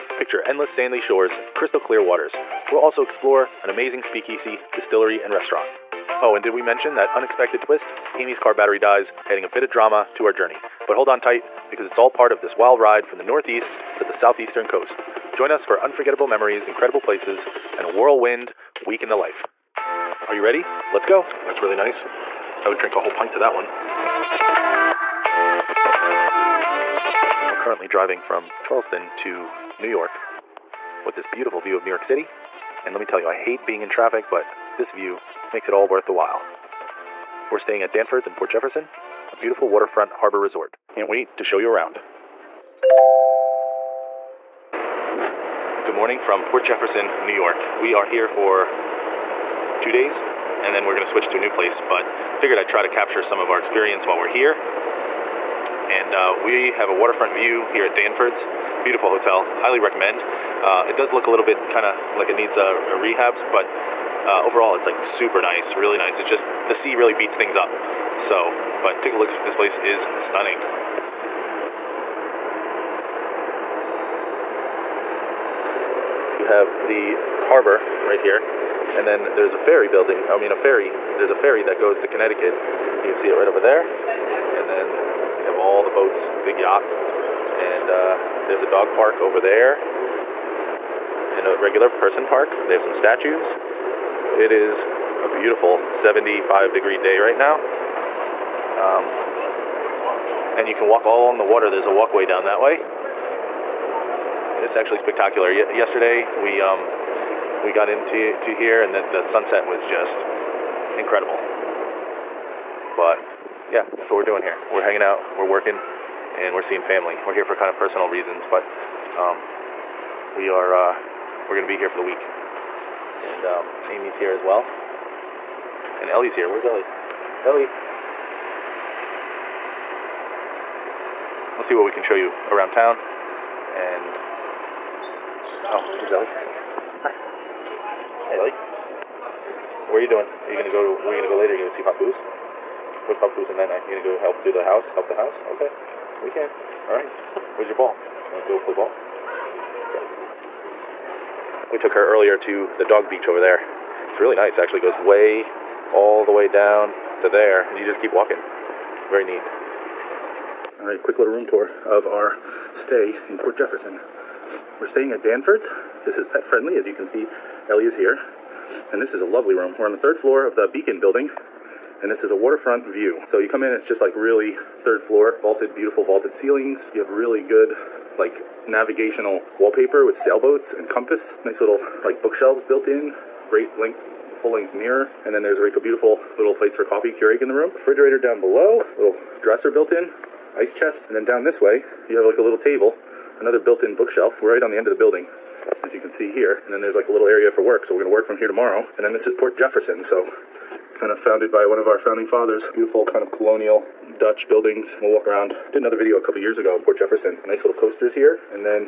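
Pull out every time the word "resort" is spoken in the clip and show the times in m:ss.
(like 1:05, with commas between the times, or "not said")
0:40.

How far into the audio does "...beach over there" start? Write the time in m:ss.
2:33.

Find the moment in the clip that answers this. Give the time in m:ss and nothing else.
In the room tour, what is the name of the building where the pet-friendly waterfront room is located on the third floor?
2:50.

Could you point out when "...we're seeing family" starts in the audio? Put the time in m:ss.
1:56.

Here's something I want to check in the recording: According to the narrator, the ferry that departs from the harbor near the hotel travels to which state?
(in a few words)
Connecticut.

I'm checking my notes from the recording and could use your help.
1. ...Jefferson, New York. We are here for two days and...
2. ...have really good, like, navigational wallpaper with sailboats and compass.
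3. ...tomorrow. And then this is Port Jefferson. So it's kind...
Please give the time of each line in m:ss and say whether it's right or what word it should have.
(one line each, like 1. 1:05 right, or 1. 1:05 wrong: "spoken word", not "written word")
1. 0:46 right
2. 2:56 right
3. 3:18 right.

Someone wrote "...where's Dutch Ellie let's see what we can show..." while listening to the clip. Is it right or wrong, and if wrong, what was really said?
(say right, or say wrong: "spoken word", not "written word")
wrong: "Ellie", not "Dutch".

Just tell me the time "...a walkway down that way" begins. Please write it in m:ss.
1:41.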